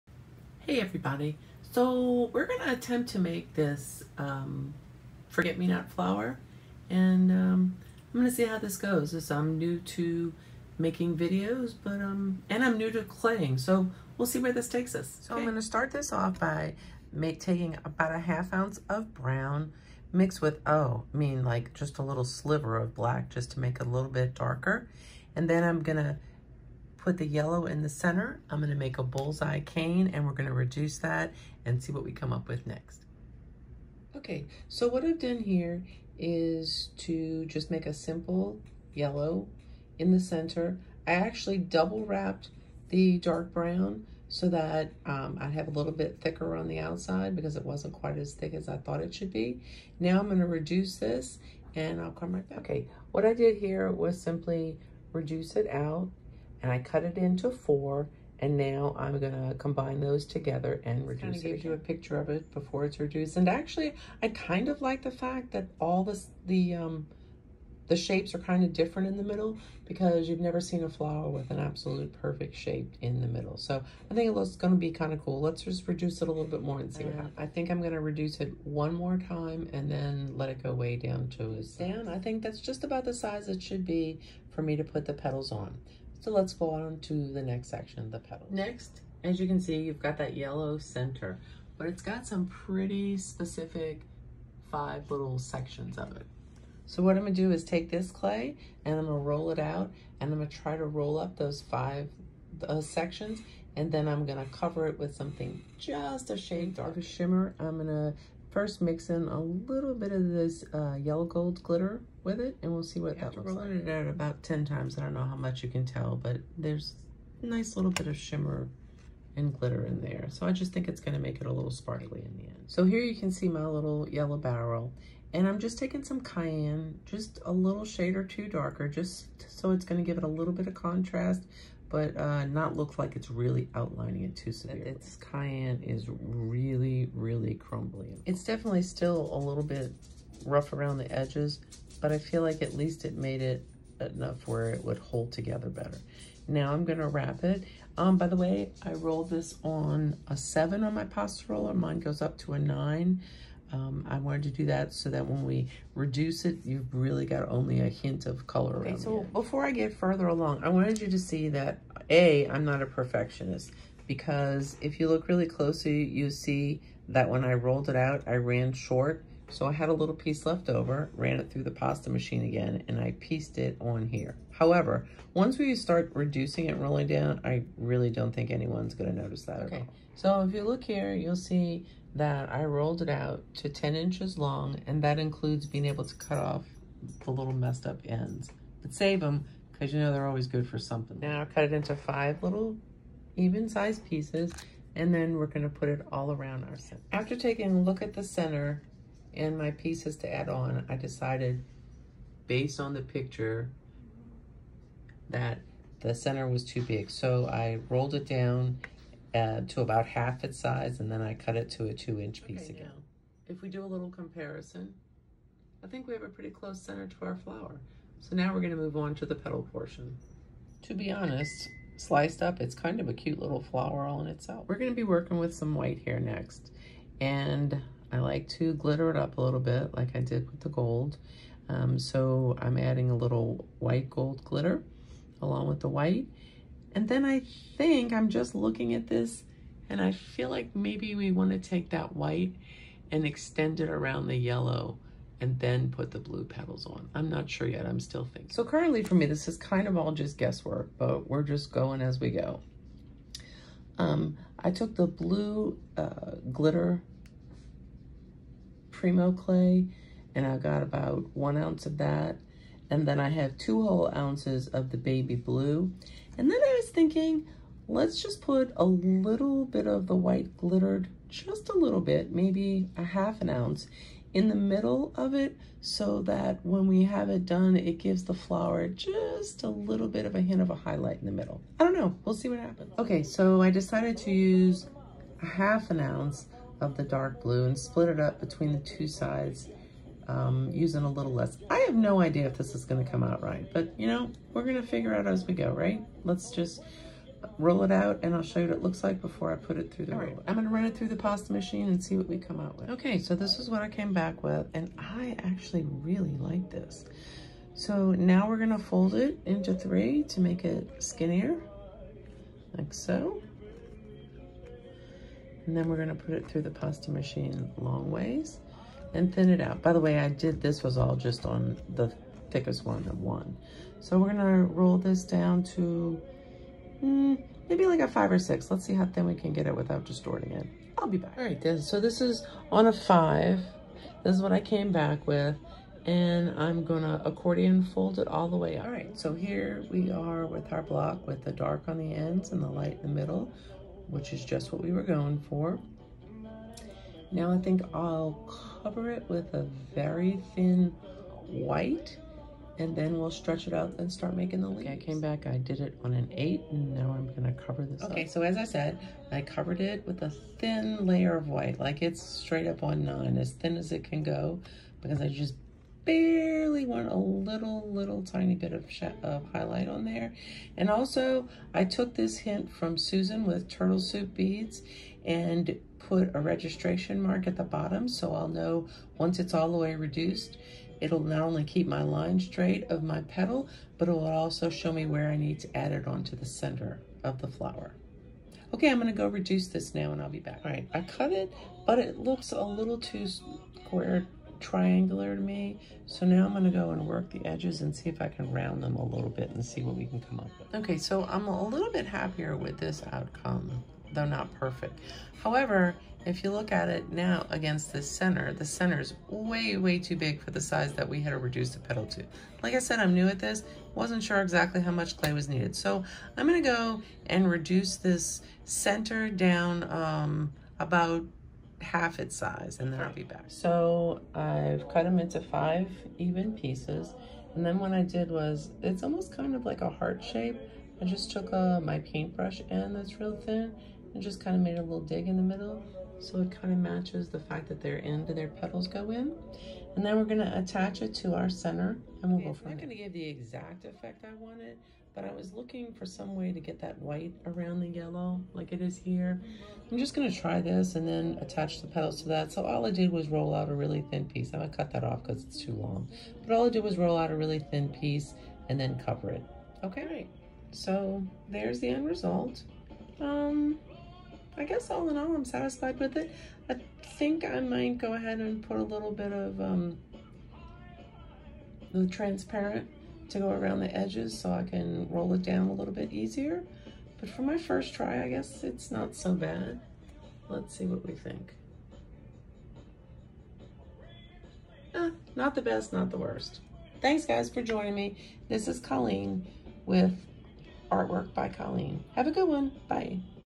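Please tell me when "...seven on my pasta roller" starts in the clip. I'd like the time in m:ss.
2:30.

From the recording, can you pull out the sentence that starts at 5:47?
Now I think I'll cover it with a very thin white and then we'll stretch it out and start making the leaves.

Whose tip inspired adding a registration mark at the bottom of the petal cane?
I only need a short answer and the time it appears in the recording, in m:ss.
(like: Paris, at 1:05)
Susan, at 6:12.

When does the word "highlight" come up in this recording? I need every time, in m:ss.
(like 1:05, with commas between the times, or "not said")
4:40, 6:09.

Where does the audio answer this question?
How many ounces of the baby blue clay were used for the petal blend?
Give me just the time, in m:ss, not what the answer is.
4:23.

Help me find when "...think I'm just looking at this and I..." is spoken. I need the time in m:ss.
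3:57.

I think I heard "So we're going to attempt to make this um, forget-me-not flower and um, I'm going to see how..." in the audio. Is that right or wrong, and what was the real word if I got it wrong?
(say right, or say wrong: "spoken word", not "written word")
right.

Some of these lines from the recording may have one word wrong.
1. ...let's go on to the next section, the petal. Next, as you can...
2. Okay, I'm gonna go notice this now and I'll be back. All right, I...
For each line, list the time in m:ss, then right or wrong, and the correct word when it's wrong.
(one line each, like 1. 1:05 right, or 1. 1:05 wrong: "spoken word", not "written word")
1. 1:26 right
2. 6:28 wrong: "reduce", not "notice".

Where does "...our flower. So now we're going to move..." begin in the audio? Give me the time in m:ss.
3:37.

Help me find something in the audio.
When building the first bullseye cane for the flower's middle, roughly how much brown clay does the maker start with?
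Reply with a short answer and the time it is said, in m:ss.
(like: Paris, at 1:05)
half ounce, at 0:18.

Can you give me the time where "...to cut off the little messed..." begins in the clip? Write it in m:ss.
3:06.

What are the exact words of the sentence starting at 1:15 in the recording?
Let's just reduce it a little bit more and see what uh, happens.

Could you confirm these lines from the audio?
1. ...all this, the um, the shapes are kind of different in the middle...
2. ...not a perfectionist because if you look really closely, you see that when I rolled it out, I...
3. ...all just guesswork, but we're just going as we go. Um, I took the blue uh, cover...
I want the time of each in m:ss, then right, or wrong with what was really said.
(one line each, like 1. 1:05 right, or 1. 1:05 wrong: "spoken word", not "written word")
1. 1:05 right
2. 2:42 right
3. 4:09 wrong: "glitter", not "cover".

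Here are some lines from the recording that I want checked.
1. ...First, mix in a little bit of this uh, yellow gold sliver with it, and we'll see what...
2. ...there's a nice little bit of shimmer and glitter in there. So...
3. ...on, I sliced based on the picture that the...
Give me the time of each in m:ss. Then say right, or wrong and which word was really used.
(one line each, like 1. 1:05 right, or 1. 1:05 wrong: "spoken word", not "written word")
1. 1:48 wrong: "glitter", not "sliver"
2. 1:56 right
3. 3:20 wrong: "decided", not "sliced".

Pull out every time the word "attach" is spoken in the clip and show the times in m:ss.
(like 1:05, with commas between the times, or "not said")
7:20, 7:31.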